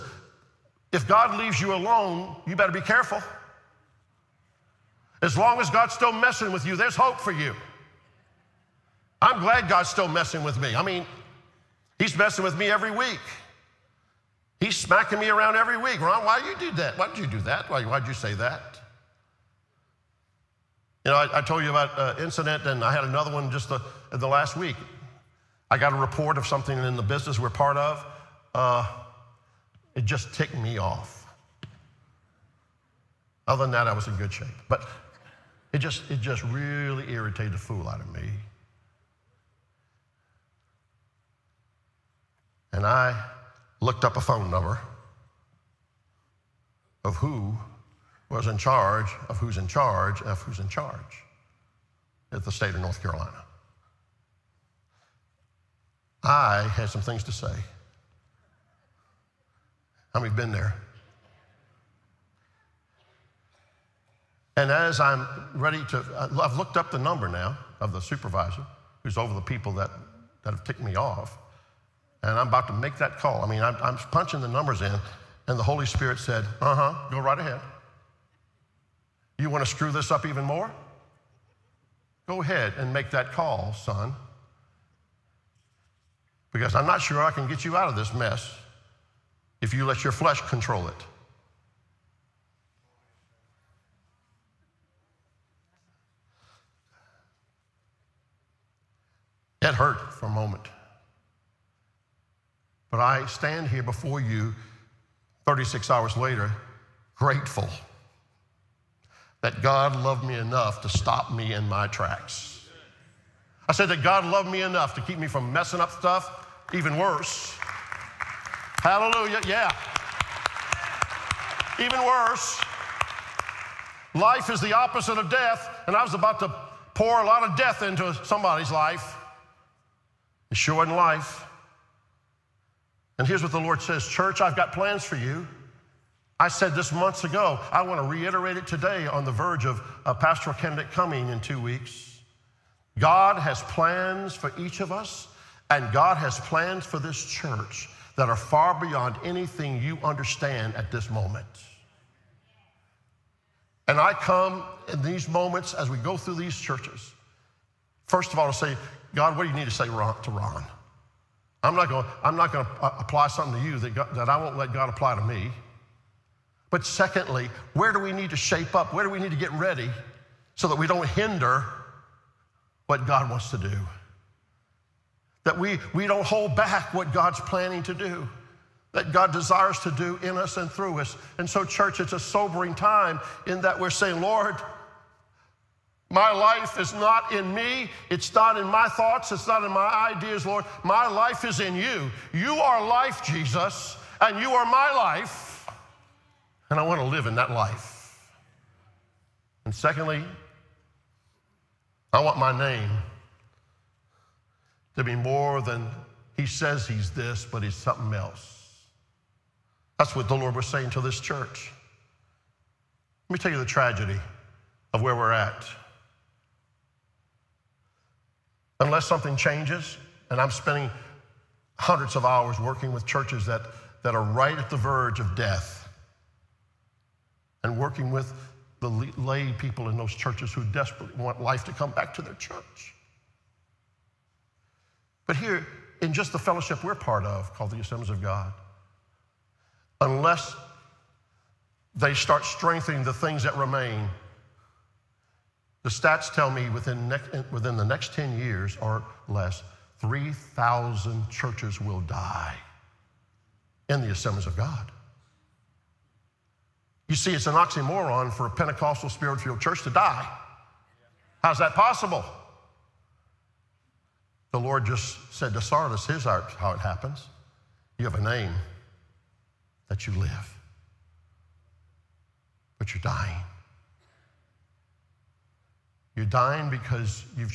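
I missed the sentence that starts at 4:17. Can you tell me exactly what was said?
You see, it's an oxymoron for a Pentecostal spirit filled church to die.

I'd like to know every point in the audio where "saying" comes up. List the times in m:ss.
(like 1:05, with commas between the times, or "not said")
3:03, 3:30.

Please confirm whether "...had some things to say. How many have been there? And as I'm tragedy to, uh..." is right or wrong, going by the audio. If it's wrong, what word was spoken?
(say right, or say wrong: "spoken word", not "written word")
wrong: "ready", not "tragedy".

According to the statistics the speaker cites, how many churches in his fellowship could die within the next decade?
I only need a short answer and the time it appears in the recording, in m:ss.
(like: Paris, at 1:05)
3,000, at 4:09.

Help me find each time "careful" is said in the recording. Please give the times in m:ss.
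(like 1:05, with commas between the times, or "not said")
0:02.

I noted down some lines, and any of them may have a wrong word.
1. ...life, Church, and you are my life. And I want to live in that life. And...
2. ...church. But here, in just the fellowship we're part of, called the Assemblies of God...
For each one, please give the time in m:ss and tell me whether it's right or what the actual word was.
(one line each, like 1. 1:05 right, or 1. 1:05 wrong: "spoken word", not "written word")
1. 3:12 wrong: "Jesus", not "Church"
2. 3:52 right.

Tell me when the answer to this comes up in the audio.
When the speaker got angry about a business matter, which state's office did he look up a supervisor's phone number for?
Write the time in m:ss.
0:52.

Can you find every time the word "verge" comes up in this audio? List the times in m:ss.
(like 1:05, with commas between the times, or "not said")
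2:19, 3:44.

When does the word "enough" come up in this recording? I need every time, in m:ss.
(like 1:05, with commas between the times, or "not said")
1:50, 1:54.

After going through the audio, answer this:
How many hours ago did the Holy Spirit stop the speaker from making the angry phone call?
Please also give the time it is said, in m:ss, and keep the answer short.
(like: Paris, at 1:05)
36, at 1:45.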